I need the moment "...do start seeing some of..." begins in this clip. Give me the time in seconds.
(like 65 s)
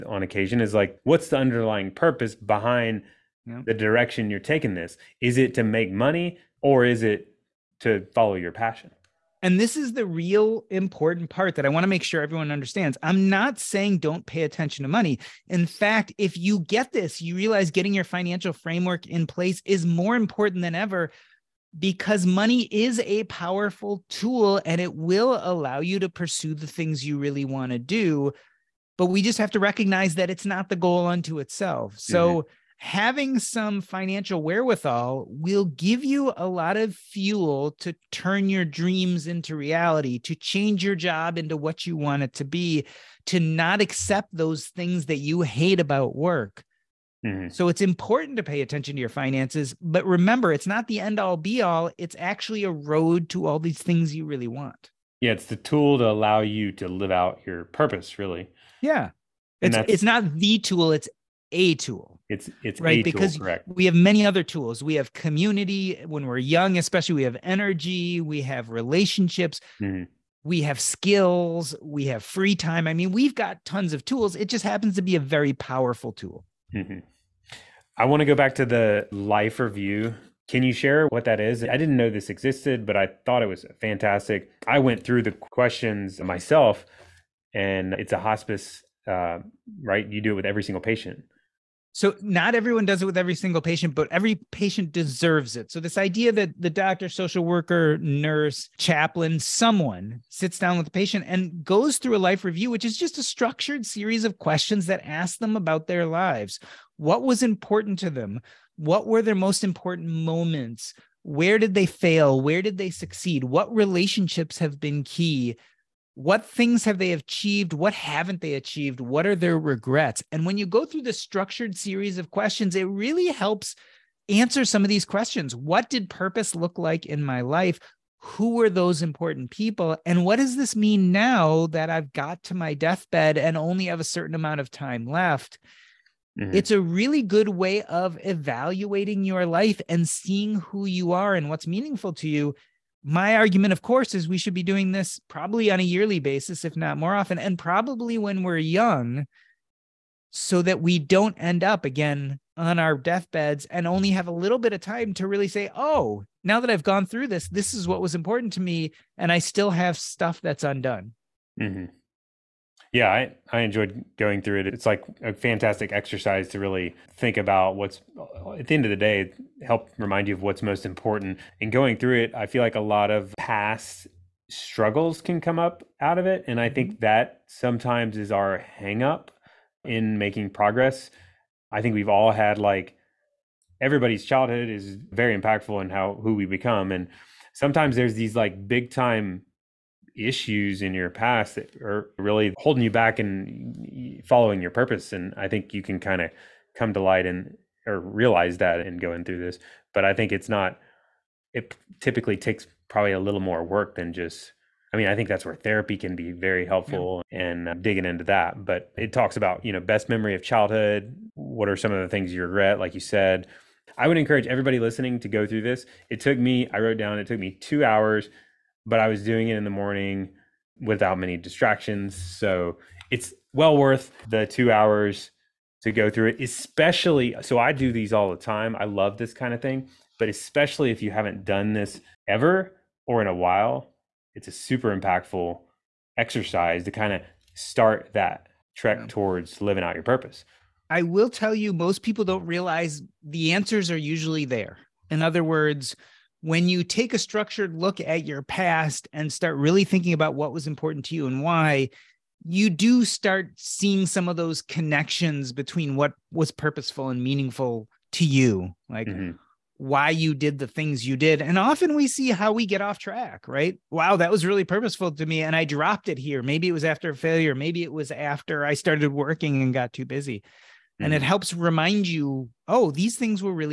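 252 s.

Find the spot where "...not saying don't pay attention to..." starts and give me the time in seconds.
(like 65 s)
13 s.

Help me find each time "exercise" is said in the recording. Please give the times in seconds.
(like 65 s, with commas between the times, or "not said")
165 s, 236 s.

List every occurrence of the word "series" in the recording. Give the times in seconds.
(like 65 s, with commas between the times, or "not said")
103 s, 121 s.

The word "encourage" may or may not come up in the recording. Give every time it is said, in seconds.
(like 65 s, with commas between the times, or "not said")
214 s.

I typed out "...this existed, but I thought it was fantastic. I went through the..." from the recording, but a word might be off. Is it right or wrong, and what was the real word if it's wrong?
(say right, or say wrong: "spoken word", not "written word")
right.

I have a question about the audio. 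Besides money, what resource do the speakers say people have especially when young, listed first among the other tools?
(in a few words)
Community.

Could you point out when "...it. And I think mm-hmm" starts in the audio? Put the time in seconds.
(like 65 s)
176 s.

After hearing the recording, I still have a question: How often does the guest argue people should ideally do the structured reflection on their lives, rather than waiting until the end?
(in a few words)
Yearly.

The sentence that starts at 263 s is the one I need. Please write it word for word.
Wow, that was really purposeful to me.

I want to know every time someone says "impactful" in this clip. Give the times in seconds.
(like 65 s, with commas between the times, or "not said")
185 s, 234 s.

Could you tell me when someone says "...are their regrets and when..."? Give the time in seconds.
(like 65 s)
119 s.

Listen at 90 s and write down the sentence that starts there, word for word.
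You do it with every single patient.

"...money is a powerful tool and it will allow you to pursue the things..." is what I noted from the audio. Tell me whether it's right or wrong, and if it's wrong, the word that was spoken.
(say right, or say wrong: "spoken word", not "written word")
right.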